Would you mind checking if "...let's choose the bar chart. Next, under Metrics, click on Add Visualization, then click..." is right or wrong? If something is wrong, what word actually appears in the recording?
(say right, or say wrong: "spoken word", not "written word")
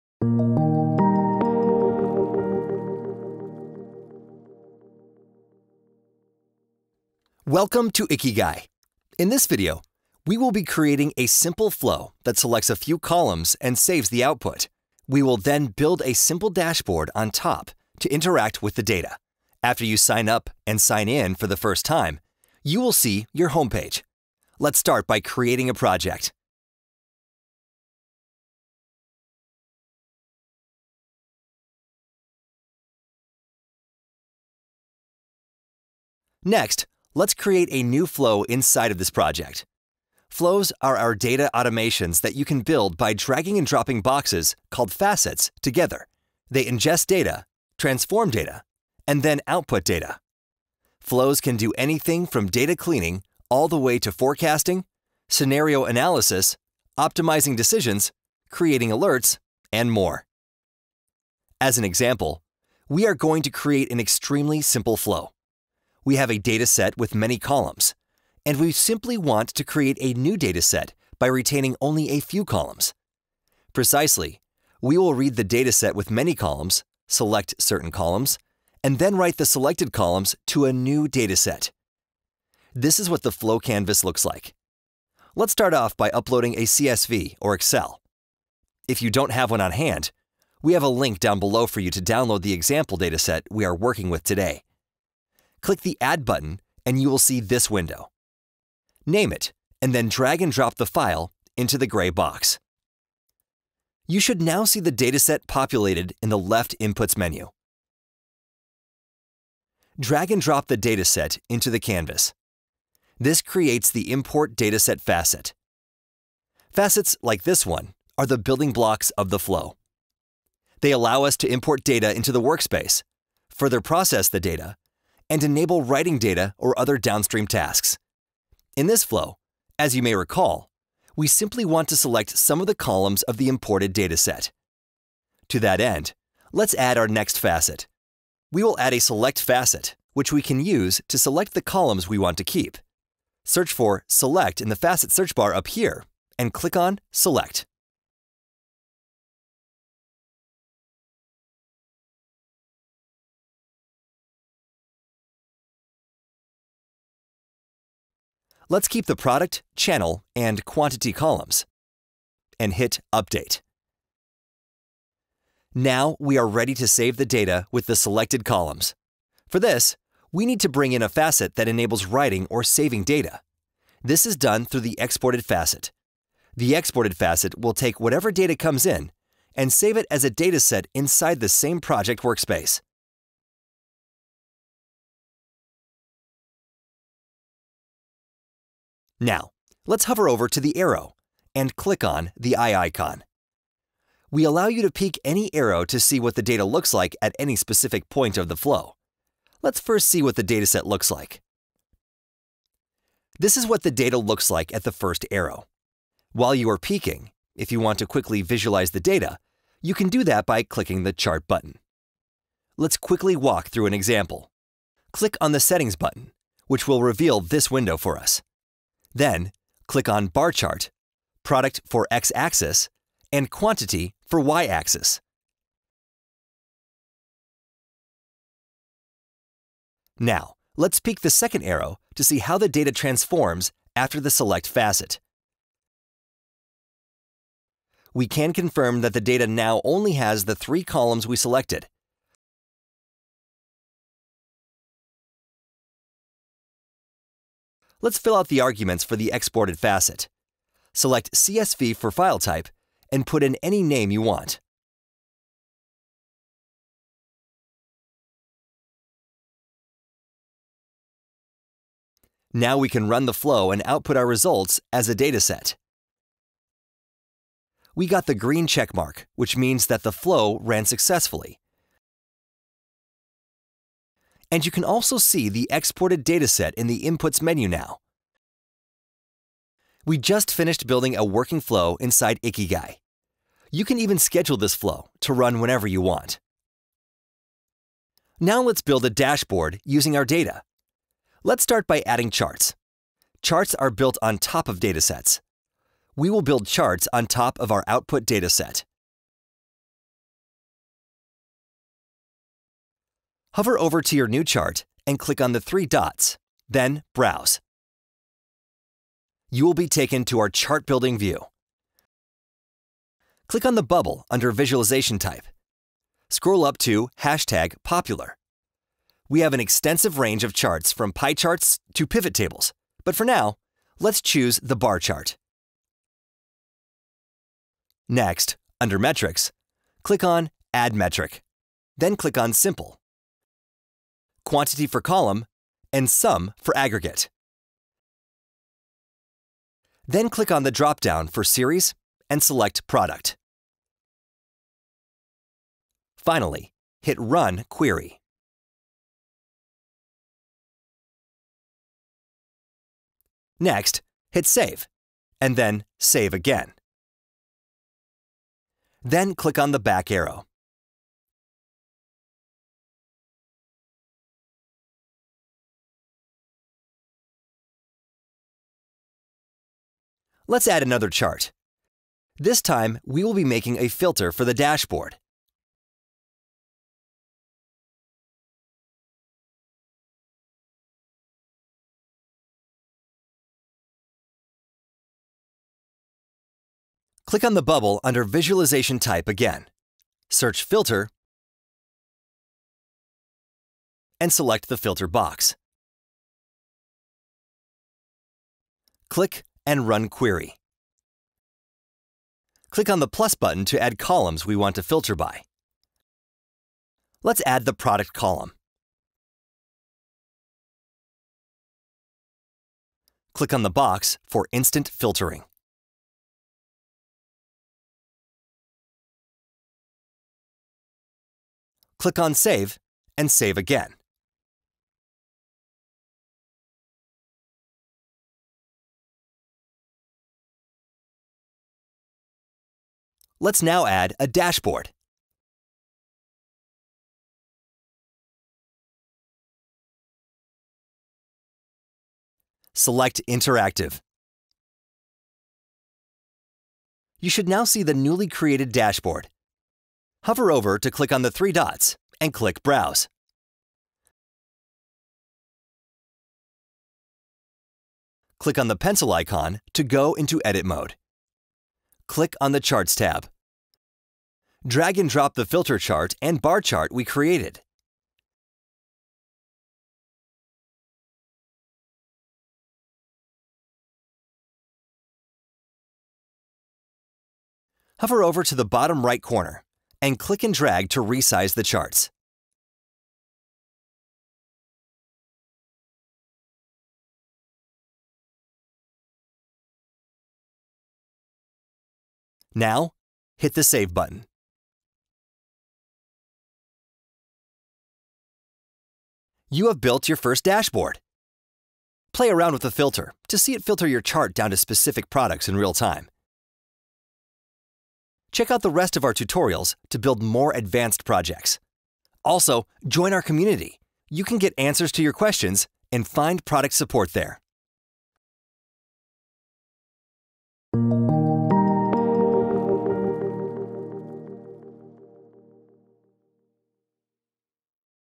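wrong: "Metric", not "Visualization".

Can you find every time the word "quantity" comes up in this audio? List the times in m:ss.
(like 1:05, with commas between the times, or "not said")
2:40, 3:43, 5:34.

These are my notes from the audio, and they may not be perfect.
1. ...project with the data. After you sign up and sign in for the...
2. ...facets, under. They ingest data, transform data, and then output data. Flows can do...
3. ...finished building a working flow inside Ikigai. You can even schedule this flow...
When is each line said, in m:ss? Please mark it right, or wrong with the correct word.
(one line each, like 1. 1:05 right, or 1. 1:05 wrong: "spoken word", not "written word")
1. 0:18 wrong: "interact", not "project"
2. 0:44 wrong: "together", not "under"
3. 4:40 right.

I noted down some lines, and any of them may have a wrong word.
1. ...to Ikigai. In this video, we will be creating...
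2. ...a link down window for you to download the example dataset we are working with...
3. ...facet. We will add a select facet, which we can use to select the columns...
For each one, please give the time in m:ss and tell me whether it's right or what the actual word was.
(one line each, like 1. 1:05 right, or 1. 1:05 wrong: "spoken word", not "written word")
1. 0:07 right
2. 1:30 wrong: "below", not "window"
3. 2:17 right.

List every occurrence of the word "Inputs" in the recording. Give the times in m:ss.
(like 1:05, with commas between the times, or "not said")
1:46, 4:37.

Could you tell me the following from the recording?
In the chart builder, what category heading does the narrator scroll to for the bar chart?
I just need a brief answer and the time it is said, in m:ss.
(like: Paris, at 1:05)
Hashtag Popular, at 5:17.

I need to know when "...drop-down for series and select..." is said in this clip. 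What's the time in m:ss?
5:40.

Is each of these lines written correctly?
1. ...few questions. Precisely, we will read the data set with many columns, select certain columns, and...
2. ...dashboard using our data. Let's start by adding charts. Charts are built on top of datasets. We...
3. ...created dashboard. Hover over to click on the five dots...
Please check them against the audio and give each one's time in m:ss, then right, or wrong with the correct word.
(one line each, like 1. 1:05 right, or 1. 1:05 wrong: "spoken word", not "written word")
1. 1:12 wrong: "columns", not "questions"
2. 4:49 right
3. 7:28 wrong: "three", not "five".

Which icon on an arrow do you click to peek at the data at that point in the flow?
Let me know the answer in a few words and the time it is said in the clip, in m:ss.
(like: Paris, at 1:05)
Eye icon, at 3:12.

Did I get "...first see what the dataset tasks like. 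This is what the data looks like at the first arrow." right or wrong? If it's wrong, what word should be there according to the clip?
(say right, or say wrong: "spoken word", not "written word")
wrong: "looks", not "tasks".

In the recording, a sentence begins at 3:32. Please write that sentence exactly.
Let's quickly walk through an example.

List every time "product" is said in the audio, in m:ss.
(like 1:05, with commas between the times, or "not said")
2:39, 3:41, 5:42, 6:47, 8:25, 8:36.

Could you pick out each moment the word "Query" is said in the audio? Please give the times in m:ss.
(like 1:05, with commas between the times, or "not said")
5:47, 6:40.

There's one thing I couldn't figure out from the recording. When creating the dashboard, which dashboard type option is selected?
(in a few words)
Interactive.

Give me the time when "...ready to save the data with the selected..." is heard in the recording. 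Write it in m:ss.
2:46.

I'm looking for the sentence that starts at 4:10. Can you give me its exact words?
Select CSV for file type and put in any name you want.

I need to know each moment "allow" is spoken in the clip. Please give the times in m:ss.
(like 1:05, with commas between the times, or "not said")
2:00, 3:14.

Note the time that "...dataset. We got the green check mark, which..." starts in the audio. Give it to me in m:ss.
4:25.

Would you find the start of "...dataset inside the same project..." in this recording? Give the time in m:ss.
3:00.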